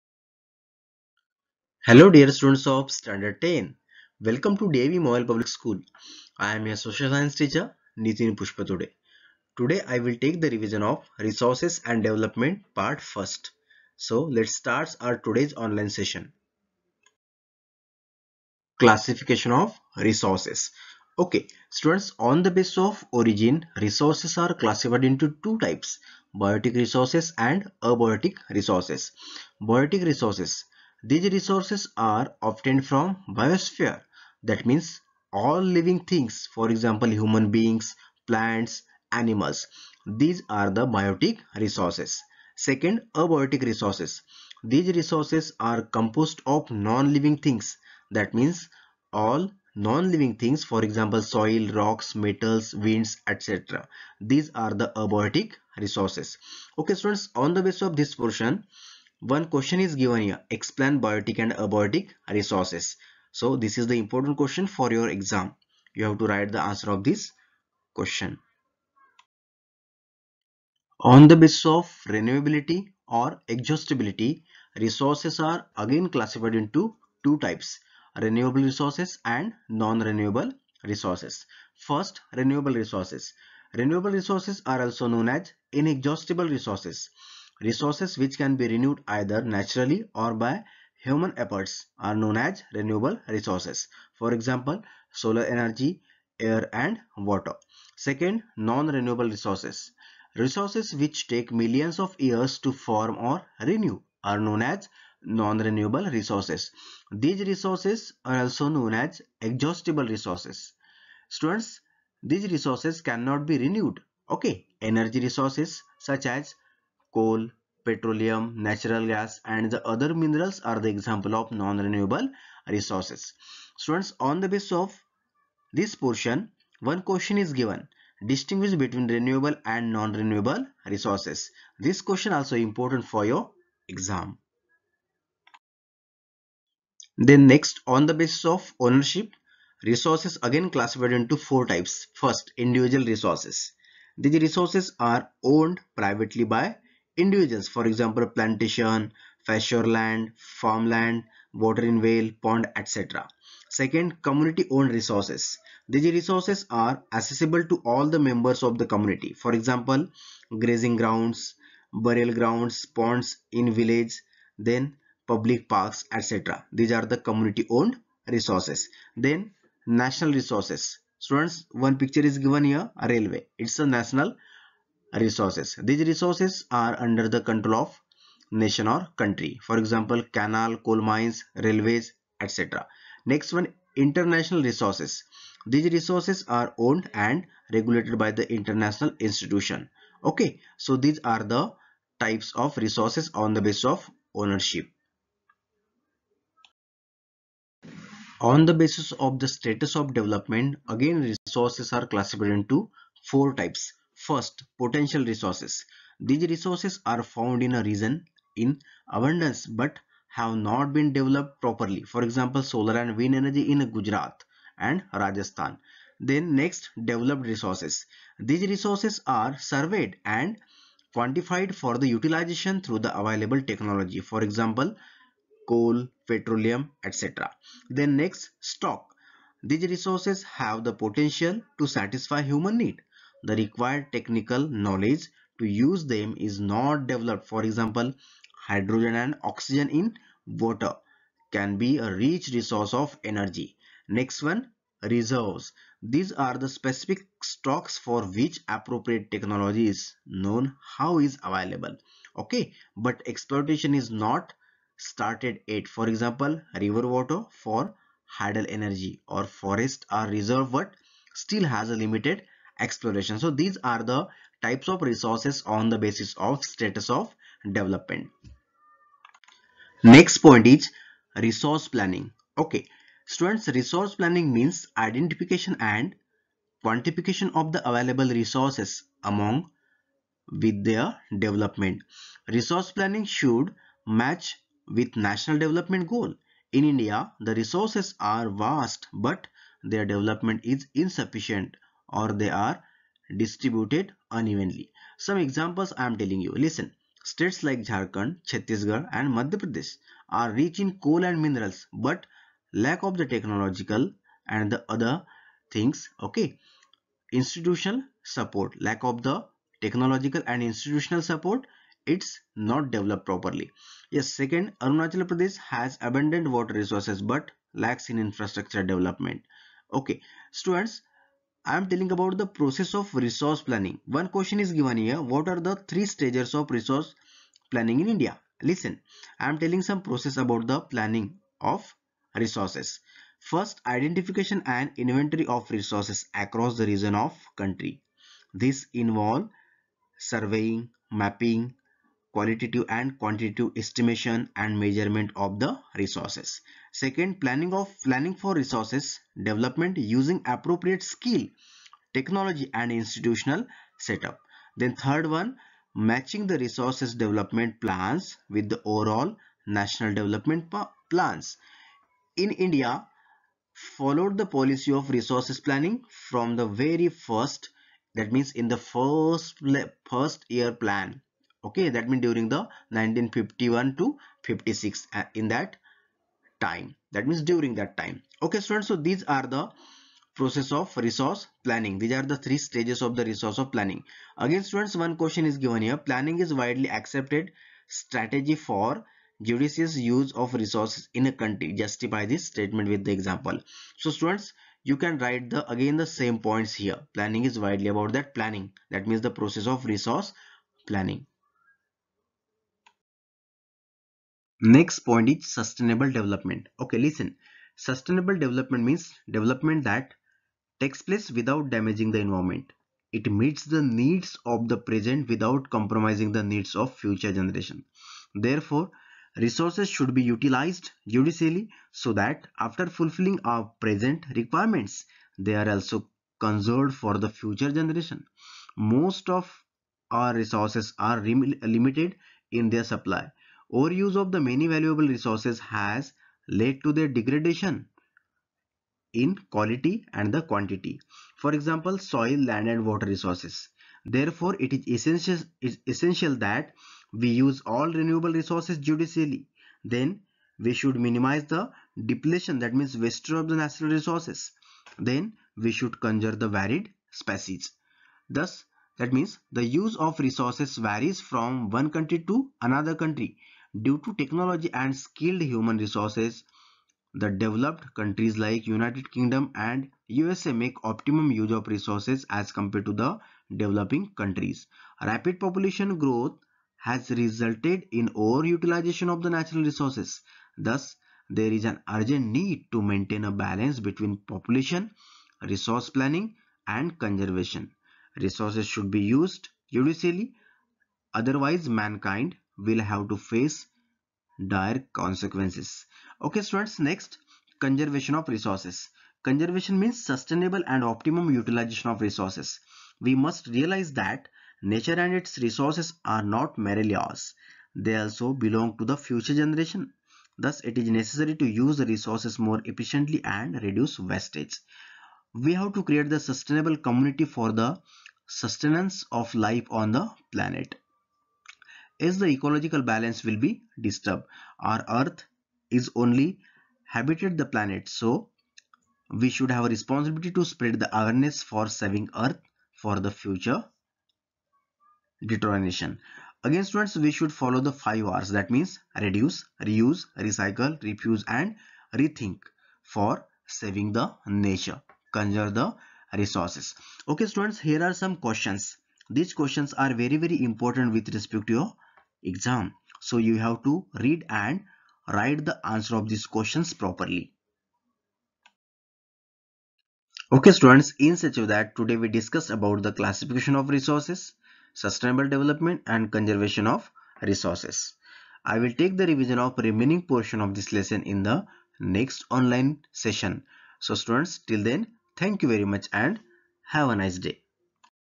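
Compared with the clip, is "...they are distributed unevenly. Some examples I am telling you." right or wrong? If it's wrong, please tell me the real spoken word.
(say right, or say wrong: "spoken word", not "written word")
right.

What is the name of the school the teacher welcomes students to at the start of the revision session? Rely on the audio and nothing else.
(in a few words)
DAV MOIL Public School.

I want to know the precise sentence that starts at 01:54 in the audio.
Okay, energy resources such as coal, petroleum, natural gas and the other minerals are the example of non-renewable resources.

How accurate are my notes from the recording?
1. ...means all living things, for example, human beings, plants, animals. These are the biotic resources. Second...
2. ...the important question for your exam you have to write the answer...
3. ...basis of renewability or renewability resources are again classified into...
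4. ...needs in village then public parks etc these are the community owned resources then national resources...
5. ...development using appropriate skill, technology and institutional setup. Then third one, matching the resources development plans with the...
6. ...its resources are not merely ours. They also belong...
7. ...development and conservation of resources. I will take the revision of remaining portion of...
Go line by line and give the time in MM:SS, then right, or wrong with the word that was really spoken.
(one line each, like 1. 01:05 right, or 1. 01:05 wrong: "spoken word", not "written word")
1. 00:34 right
2. 01:03 right
3. 01:11 wrong: "exhaustibility", not "renewability"
4. 02:42 wrong: "ponds", not "needs"
5. 05:49 right
6. 08:25 right
7. 09:25 right.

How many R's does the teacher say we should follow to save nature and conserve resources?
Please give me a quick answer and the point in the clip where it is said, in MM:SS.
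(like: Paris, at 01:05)
5, at 08:57.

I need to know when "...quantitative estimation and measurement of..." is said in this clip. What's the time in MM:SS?
05:43.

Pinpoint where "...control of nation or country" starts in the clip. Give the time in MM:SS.
02:57.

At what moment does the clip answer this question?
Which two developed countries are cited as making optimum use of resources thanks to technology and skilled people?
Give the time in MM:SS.
07:48.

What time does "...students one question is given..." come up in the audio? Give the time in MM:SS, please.
06:24.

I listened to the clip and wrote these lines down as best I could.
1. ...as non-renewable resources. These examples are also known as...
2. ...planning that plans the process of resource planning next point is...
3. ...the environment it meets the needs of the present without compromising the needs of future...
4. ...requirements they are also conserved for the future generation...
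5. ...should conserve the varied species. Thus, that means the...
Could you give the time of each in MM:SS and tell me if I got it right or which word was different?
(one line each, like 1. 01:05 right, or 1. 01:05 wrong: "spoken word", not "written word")
1. 01:44 wrong: "resources", not "examples"
2. 06:38 wrong: "means", not "plans"
3. 06:52 right
4. 07:04 right
5. 07:35 right.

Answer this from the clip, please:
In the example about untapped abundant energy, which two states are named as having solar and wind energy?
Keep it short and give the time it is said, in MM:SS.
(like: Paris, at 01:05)
Gujarat and Rajasthan, at 03:33.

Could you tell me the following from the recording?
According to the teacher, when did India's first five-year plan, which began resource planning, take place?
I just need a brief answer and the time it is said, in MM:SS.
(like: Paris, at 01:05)
1951 to 1956, at 06:12.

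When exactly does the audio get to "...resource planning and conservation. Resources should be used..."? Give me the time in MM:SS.
08:05.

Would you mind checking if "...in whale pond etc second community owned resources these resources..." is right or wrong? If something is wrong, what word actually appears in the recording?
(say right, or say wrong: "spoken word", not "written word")
right.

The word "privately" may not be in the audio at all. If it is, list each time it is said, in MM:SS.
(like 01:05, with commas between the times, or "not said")
02:25.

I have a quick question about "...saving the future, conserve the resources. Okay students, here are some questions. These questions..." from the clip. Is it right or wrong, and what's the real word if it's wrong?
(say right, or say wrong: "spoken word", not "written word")
wrong: "nature", not "future".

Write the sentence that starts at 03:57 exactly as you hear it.
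For example, hydrogen and oxygen in water can be a rich resource of energy.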